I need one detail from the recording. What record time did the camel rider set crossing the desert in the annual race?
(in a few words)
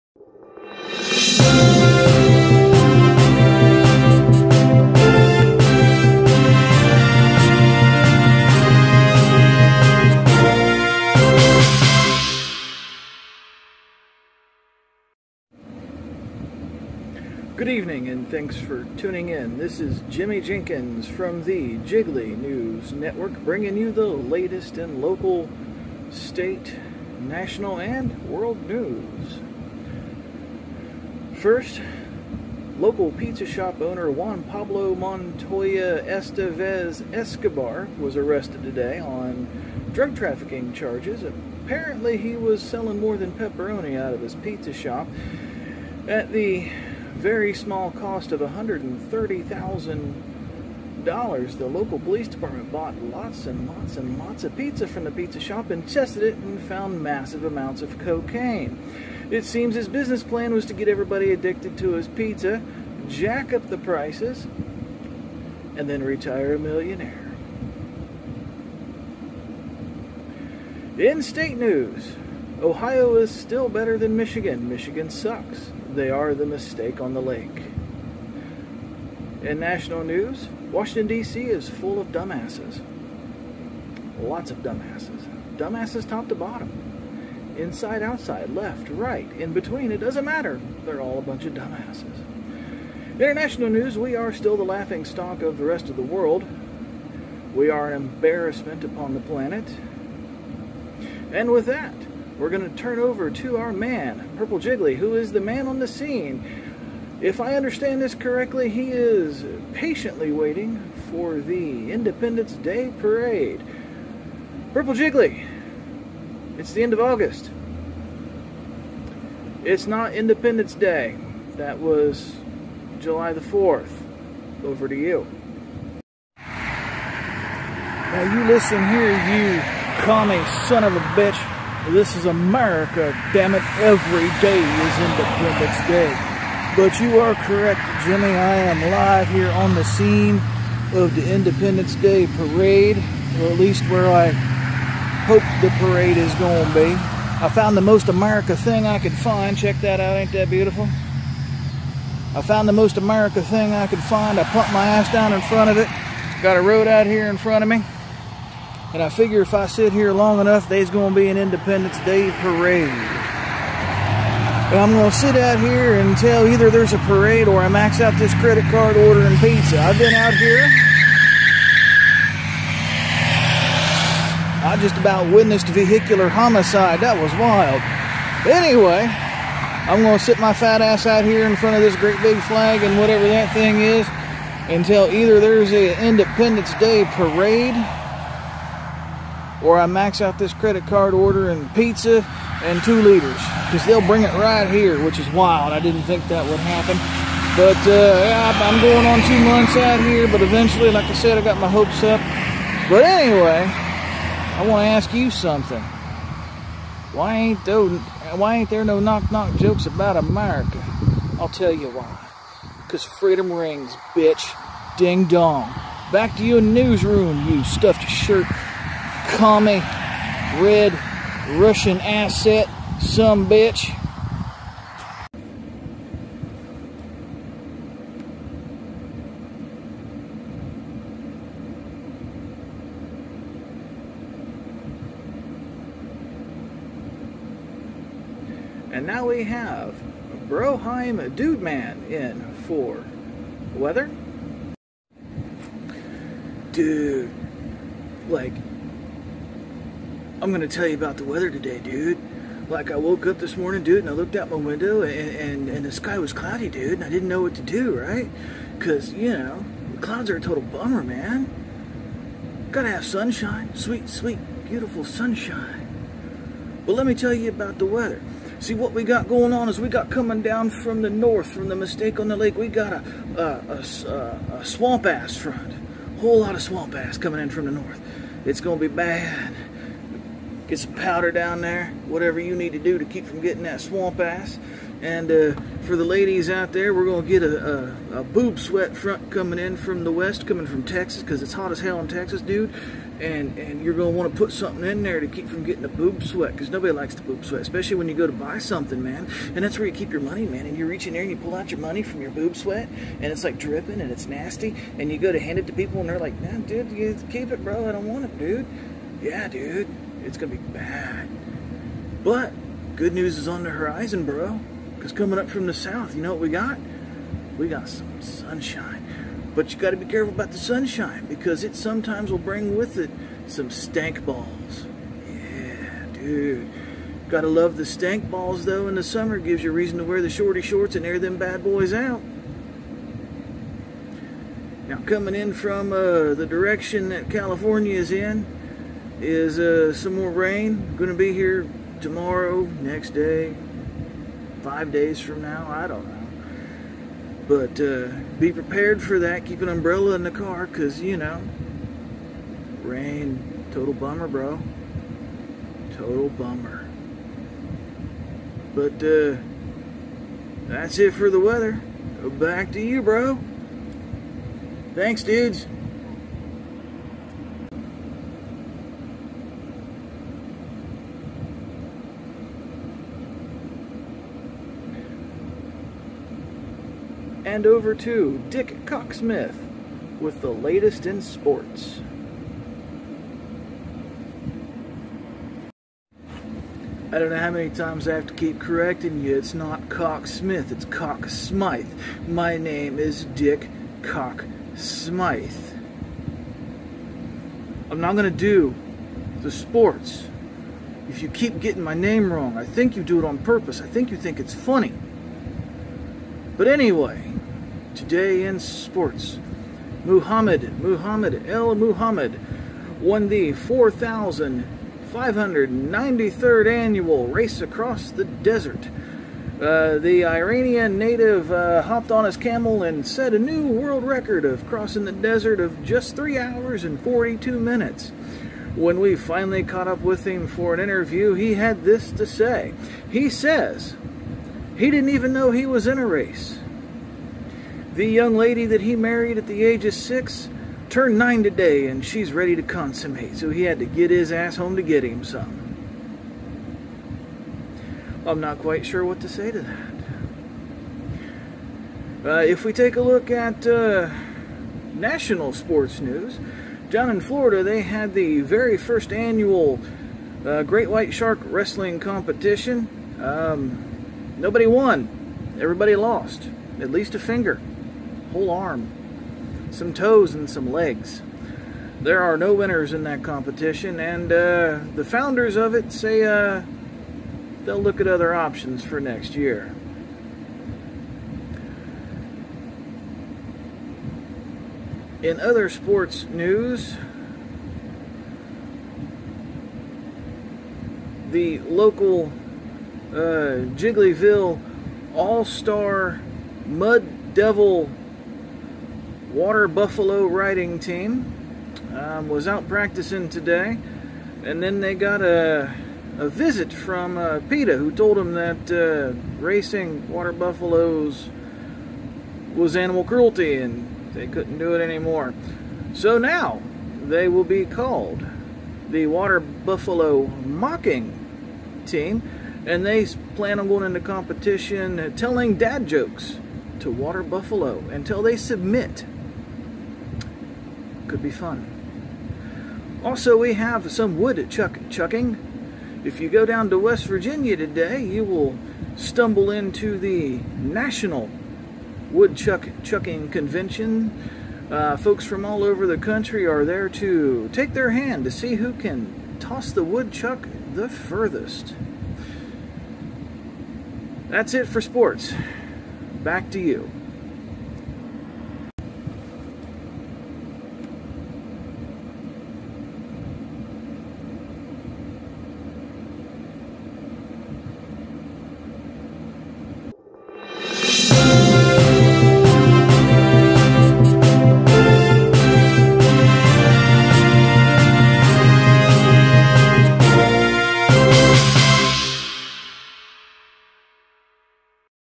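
3 hours and 42 minutes.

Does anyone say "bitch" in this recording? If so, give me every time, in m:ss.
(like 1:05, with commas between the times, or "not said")
2:11, 3:34, 3:43.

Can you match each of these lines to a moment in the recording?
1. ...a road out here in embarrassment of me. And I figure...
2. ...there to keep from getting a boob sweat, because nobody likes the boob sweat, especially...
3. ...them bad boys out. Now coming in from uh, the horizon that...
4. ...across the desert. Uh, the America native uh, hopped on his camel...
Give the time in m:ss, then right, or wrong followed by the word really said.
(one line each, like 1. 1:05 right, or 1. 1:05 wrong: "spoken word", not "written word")
1. 2:36 wrong: "front", not "embarrassment"
2. 4:55 right
3. 5:31 wrong: "direction", not "horizon"
4. 6:57 wrong: "Iranian", not "America".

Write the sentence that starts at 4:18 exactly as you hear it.
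Cause you know, clouds are a total bummer, man.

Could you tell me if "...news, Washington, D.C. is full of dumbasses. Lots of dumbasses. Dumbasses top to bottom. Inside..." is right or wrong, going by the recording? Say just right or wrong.
right.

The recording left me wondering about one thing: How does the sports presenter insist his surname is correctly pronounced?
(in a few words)
Cocksmythe.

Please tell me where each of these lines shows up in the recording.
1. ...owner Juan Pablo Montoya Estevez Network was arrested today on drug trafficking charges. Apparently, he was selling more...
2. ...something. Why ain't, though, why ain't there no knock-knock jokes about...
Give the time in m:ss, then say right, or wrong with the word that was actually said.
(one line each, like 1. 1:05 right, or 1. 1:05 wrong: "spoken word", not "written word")
1. 0:33 wrong: "Escobar", not "Network"
2. 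3:25 right.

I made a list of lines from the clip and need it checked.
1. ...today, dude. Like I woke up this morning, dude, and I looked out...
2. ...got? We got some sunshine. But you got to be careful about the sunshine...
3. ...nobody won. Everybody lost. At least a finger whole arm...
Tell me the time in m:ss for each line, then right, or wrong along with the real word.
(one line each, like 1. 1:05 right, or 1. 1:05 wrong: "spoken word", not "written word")
1. 4:11 right
2. 5:16 right
3. 7:44 right.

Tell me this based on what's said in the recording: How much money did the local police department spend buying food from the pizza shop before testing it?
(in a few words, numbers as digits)
$130,000.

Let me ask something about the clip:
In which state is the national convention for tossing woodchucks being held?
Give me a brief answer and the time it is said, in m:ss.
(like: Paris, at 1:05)
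West Virginia, at 8:56.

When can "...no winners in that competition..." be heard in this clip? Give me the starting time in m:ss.
7:52.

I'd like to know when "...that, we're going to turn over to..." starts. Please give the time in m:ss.
1:41.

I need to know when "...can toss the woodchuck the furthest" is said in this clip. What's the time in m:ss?
9:08.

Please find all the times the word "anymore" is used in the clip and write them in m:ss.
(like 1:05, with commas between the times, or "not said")
8:34.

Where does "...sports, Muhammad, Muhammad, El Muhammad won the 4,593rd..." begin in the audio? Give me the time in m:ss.
6:48.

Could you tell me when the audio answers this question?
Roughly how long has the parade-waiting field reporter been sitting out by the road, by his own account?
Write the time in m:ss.
3:19.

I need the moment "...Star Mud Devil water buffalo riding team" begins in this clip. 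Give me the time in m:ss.
8:15.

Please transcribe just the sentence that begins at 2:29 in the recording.
Check that out, ain't that beautiful?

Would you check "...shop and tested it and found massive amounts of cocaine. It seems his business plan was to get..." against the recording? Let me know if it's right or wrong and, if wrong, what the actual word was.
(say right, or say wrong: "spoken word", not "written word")
right.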